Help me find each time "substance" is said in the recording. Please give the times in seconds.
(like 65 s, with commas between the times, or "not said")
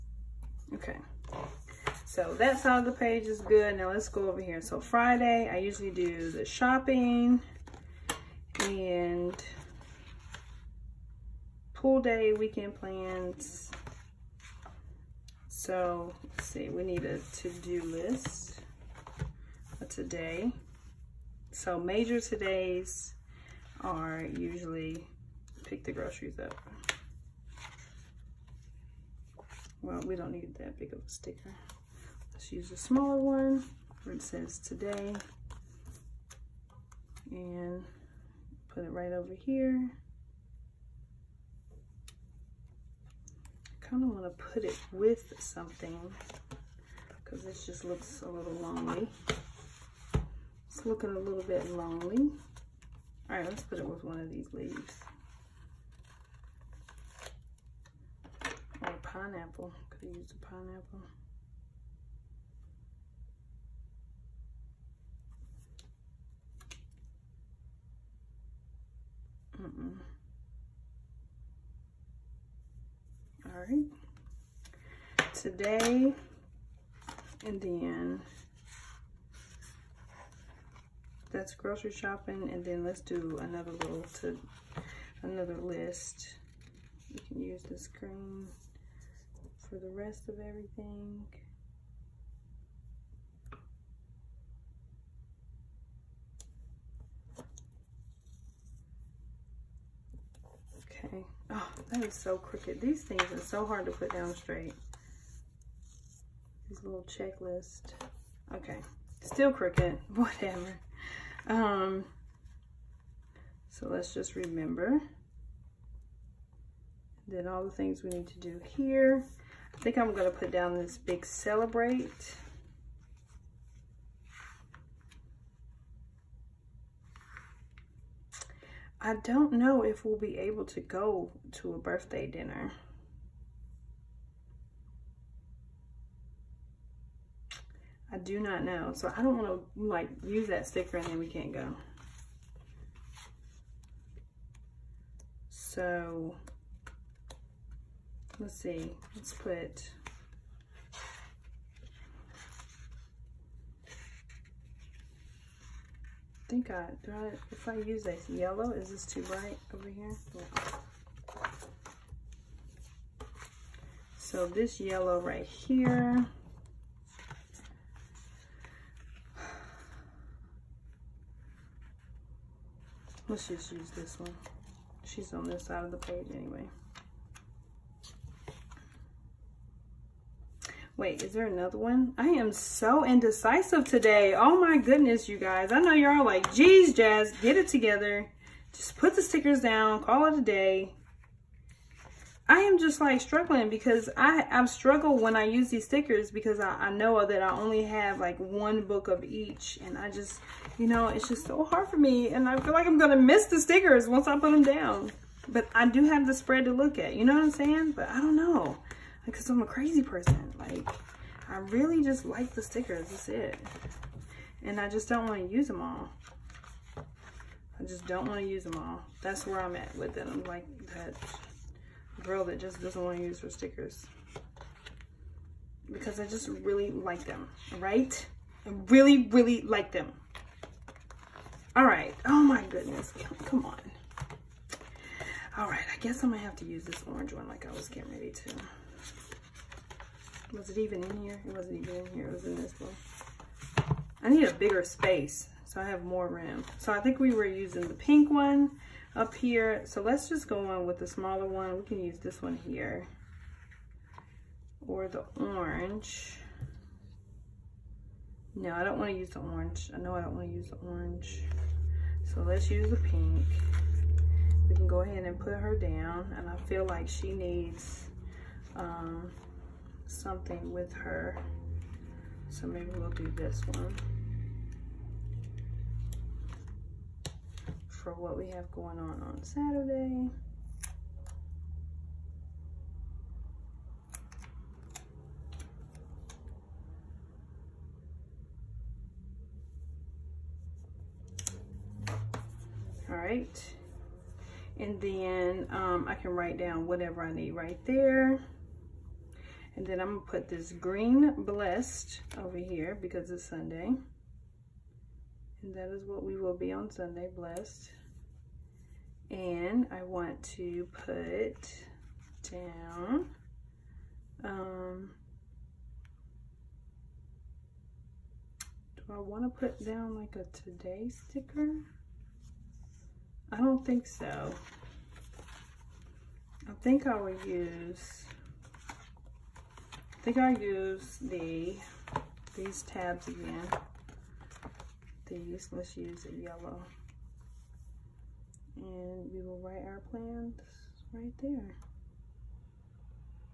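not said.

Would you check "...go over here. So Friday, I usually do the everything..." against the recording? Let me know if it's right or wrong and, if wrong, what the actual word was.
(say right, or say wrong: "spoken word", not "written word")
wrong: "shopping", not "everything".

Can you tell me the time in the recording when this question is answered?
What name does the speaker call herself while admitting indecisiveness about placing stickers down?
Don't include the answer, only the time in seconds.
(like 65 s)
186 s.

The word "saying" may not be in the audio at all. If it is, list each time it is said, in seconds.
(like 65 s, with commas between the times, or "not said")
207 s.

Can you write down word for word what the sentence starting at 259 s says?
I know I don't want to use the orange.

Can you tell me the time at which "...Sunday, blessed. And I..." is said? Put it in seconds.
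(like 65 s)
306 s.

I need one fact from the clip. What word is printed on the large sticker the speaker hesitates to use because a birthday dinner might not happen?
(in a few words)
Celebrate.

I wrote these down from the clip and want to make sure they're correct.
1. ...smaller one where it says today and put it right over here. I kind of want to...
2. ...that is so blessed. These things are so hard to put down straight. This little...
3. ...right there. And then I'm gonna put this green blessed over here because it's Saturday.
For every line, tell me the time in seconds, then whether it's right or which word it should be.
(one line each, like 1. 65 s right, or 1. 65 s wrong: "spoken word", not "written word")
1. 32 s right
2. 101 s wrong: "crooked", not "blessed"
3. 297 s wrong: "Sunday", not "Saturday".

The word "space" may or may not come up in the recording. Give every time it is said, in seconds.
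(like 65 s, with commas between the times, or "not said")
244 s.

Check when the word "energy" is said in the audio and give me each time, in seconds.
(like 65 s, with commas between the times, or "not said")
not said.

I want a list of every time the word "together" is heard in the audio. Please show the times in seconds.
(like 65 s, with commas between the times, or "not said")
187 s.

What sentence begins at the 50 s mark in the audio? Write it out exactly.
It's looking a little bit lonely.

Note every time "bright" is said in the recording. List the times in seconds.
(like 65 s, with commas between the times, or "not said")
159 s.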